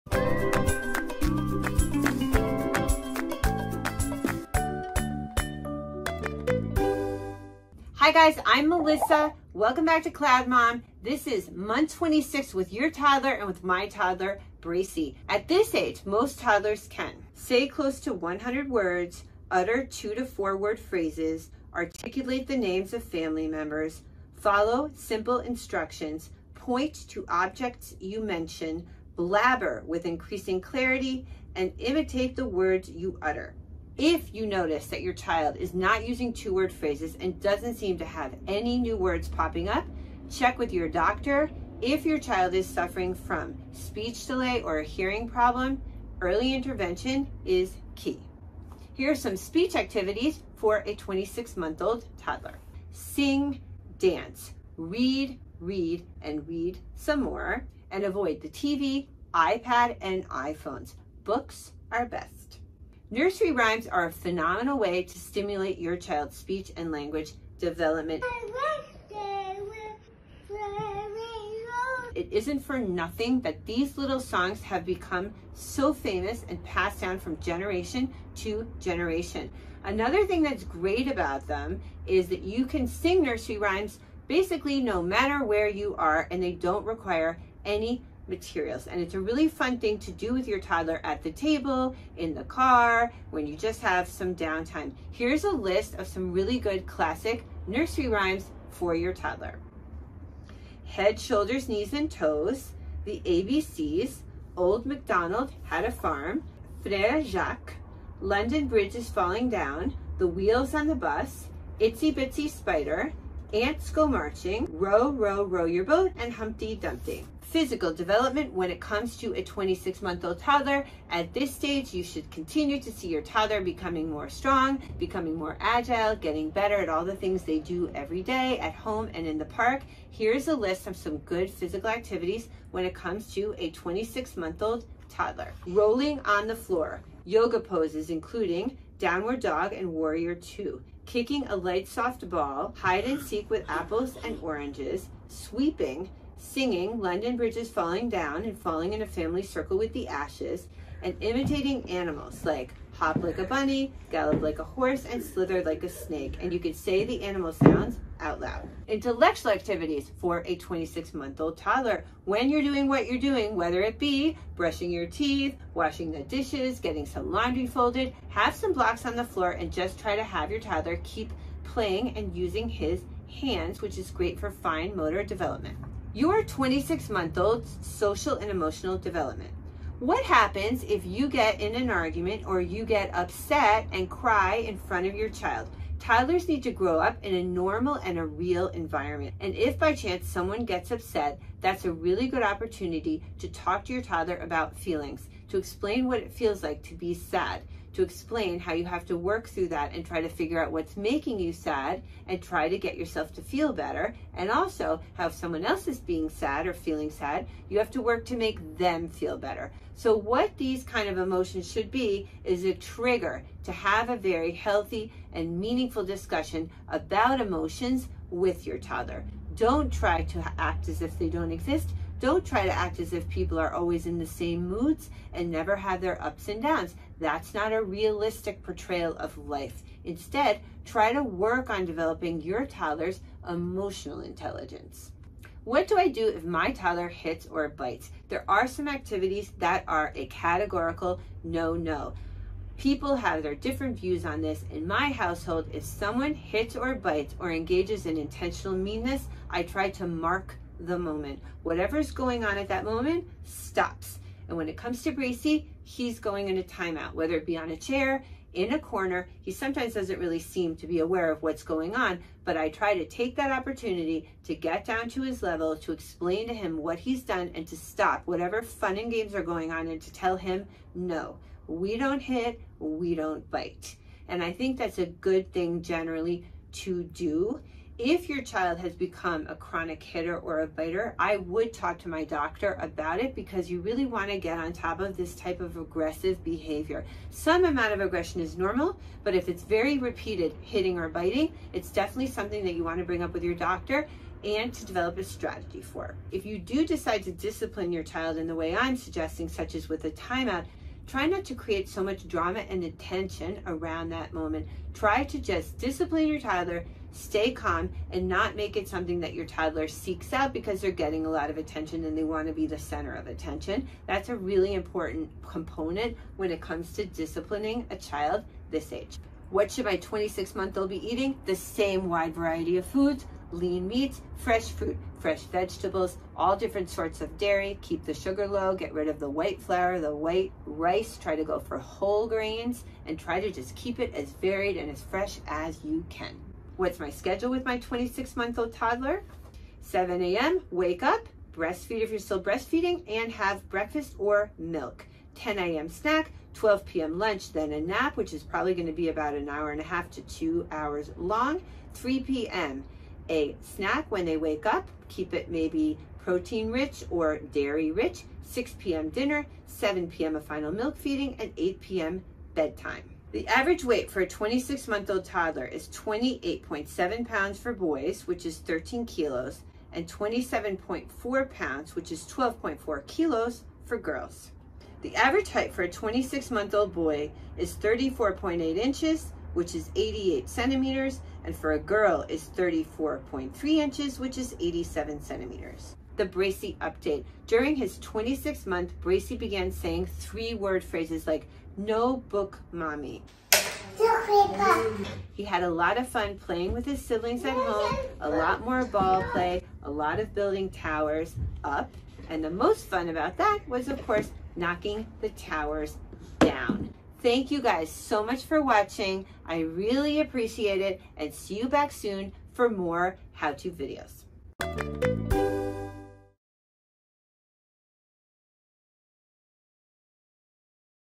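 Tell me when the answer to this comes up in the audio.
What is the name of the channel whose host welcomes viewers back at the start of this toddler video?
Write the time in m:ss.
0:10.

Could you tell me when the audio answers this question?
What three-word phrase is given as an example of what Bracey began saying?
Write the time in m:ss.
6:31.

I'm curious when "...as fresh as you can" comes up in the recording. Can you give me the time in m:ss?
5:34.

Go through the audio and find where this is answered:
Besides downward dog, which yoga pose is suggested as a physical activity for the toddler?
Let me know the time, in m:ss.
2:19.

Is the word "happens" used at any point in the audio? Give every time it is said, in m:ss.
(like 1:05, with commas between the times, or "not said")
3:00.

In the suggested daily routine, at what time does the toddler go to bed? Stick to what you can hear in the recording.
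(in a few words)
8 p.m.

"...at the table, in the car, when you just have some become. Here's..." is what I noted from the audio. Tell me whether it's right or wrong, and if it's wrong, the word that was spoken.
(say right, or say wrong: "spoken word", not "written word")
wrong: "downtime", not "become".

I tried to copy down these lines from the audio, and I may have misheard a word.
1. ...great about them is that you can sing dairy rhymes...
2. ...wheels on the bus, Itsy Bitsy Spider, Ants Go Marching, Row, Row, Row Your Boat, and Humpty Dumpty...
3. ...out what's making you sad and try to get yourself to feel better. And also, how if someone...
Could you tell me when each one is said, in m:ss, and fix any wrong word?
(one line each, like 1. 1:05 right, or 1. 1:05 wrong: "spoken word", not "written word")
1. 1:20 wrong: "nursery", not "dairy"
2. 1:50 right
3. 3:20 right.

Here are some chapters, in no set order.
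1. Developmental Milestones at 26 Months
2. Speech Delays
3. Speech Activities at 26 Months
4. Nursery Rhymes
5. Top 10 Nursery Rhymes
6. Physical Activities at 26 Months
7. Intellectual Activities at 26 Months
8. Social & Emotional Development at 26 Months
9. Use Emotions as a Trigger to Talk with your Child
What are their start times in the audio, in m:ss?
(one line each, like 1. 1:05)
1. 0:16
2. 0:34
3. 0:49
4. 1:03
5. 1:40
6. 1:57
7. 2:39
8. 2:56
9. 3:30.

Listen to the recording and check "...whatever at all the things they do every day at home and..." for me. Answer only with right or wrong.
wrong.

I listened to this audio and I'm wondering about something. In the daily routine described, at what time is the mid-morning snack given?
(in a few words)
10 a.m.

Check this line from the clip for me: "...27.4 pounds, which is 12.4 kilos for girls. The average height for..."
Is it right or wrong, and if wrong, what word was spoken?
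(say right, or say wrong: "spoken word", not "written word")
right.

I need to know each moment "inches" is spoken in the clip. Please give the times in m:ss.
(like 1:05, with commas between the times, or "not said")
6:18, 6:23.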